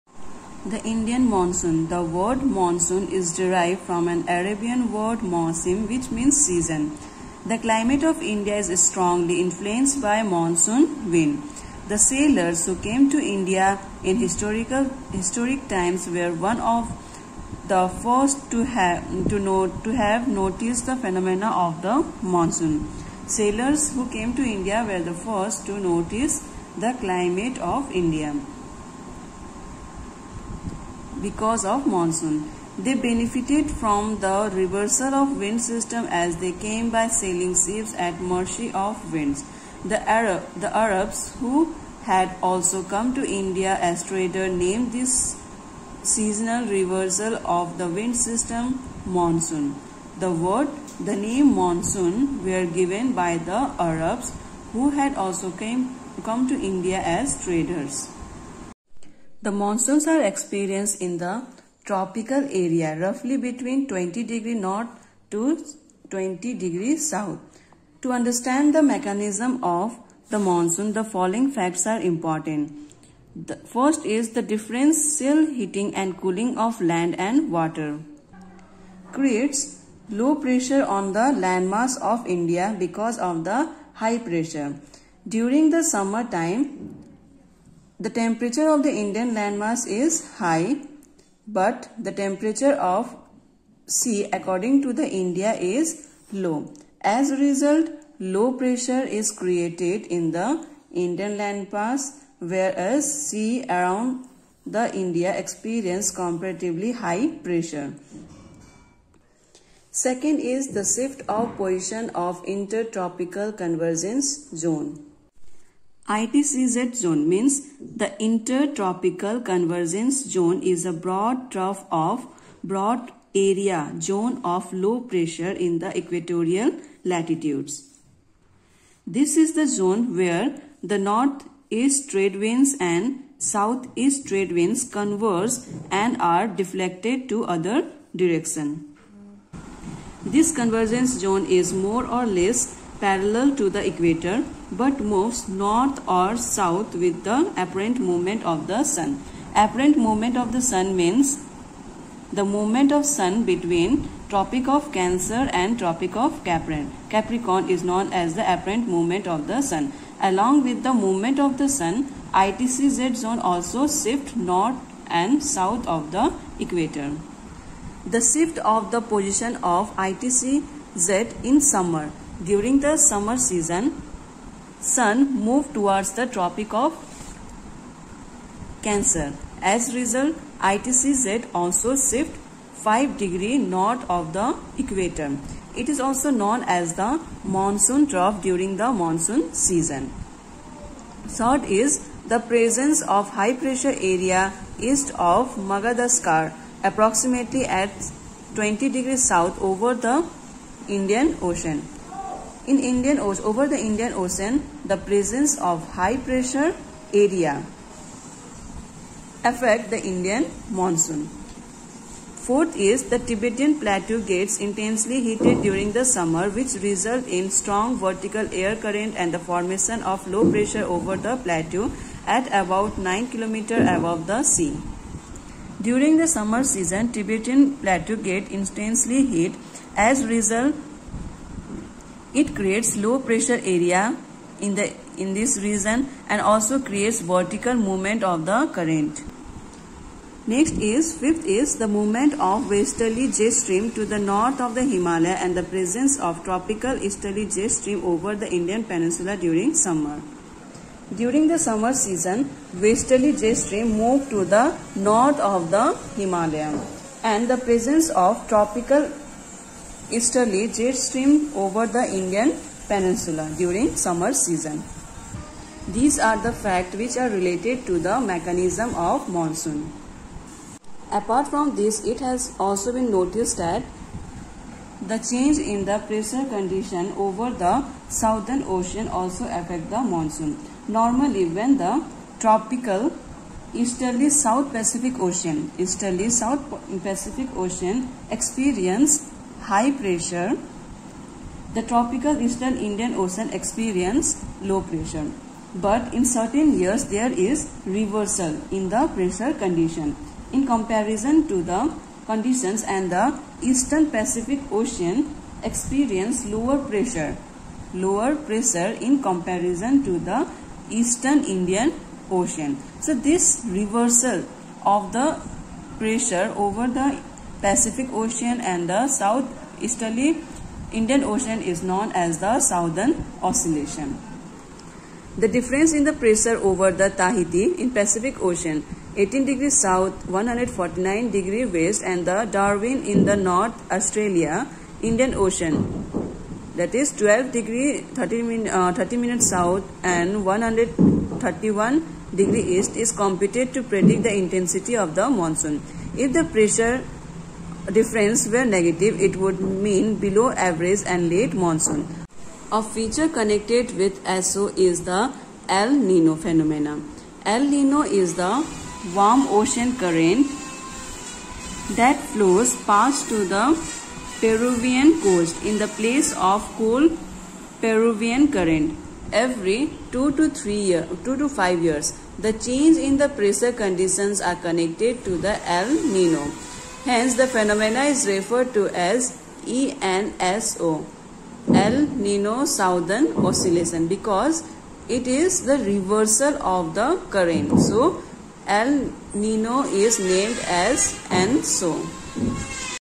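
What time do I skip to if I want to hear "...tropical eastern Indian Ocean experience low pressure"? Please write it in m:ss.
4:51.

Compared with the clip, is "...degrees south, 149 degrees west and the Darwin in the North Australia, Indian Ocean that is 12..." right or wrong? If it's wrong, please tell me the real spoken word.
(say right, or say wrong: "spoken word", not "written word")
right.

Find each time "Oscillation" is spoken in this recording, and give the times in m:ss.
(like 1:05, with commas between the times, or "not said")
5:23, 6:23.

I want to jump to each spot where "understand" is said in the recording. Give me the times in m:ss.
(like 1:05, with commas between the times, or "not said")
1:08.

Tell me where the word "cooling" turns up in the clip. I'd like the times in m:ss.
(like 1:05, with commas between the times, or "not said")
1:16.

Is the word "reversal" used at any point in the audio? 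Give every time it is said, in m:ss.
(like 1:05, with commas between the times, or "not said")
0:34, 0:46, 4:57, 5:13, 6:25.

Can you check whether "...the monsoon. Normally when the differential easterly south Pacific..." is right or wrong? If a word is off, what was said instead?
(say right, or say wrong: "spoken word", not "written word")
wrong: "tropical", not "differential".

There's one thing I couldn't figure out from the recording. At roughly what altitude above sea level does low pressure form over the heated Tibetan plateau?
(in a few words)
9 km.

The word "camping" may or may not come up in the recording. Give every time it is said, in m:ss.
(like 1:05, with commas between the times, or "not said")
not said.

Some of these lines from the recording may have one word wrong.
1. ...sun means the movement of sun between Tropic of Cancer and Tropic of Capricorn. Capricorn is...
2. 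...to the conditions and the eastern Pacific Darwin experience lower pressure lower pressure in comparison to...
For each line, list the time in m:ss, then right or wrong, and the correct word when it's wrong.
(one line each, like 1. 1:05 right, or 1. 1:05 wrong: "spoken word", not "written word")
1. 2:30 right
2. 5:01 wrong: "Ocean", not "Darwin".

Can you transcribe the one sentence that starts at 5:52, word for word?
A feature connected with ESO is the El Nino phenomena.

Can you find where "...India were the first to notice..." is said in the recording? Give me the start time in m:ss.
0:24.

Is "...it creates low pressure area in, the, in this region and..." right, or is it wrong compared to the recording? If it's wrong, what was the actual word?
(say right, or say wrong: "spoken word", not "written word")
right.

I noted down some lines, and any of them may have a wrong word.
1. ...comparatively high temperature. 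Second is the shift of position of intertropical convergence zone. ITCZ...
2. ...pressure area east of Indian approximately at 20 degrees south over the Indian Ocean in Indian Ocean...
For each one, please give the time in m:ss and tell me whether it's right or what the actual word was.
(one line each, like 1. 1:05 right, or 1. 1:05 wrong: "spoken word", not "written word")
1. 1:46 wrong: "pressure", not "temperature"
2. 3:13 wrong: "Madagascar", not "Indian".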